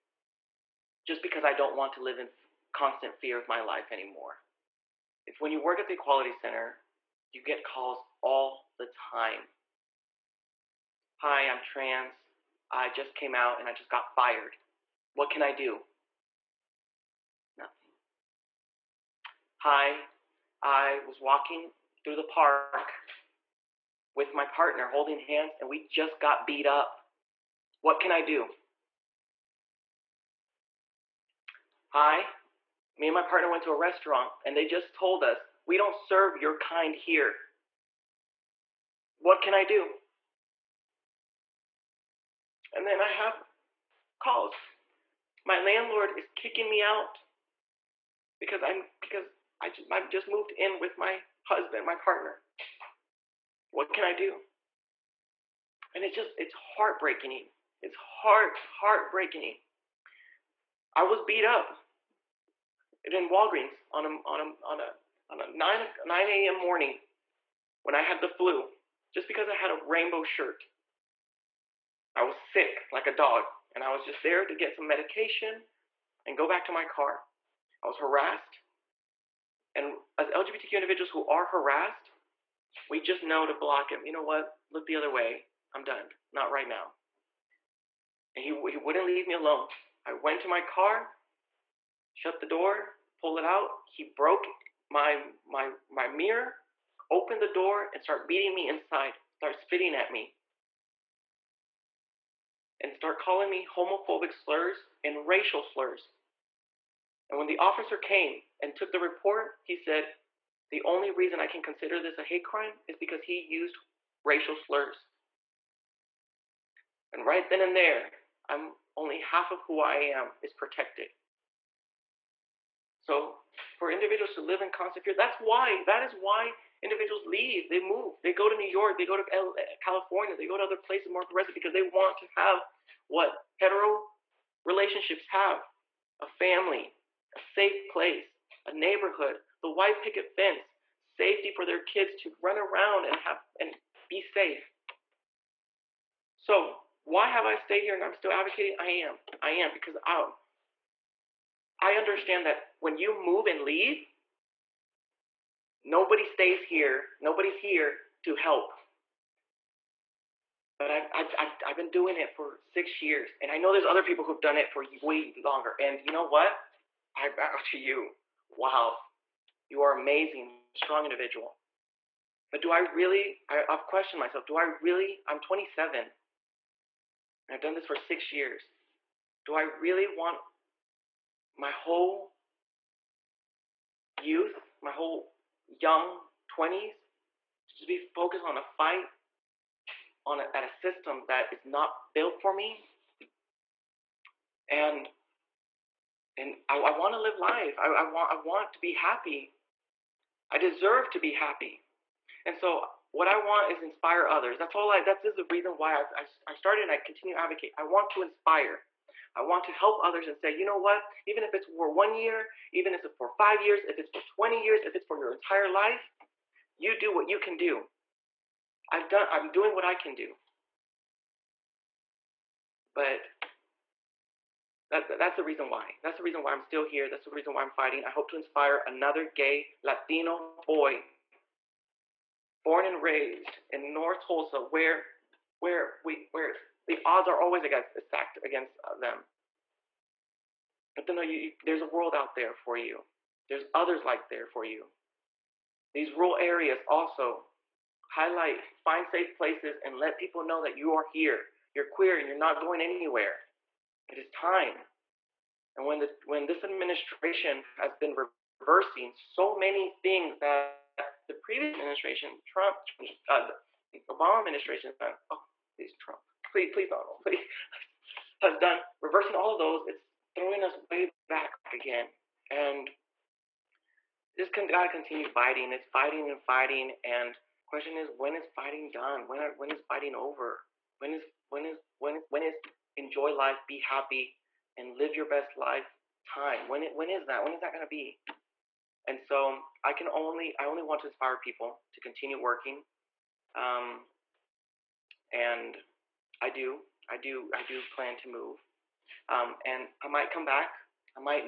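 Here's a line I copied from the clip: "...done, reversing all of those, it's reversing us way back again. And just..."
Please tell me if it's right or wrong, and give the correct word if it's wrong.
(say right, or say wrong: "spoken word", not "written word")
wrong: "throwing", not "reversing".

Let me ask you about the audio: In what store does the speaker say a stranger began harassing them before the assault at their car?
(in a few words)
Walgreens.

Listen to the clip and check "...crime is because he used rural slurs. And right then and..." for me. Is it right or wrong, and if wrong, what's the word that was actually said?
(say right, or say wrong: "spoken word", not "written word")
wrong: "racial", not "rural".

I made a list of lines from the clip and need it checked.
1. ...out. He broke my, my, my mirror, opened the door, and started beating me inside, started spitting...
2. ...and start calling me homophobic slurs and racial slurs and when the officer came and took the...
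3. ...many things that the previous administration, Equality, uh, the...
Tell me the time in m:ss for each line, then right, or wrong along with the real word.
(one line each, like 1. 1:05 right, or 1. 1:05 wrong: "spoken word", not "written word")
1. 1:33 right
2. 1:42 right
3. 4:19 wrong: "Trump", not "Equality".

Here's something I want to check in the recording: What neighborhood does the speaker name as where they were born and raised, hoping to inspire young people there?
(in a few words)
North Tulsa.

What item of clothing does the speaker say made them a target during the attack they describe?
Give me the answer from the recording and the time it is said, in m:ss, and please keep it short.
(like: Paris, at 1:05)
rainbow shirt, at 1:09.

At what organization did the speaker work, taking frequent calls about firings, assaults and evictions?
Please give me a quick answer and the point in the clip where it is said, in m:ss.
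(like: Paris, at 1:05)
Equality Center, at 0:05.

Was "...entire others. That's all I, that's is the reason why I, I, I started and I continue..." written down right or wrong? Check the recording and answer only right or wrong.
wrong.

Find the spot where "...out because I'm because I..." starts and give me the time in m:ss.
0:46.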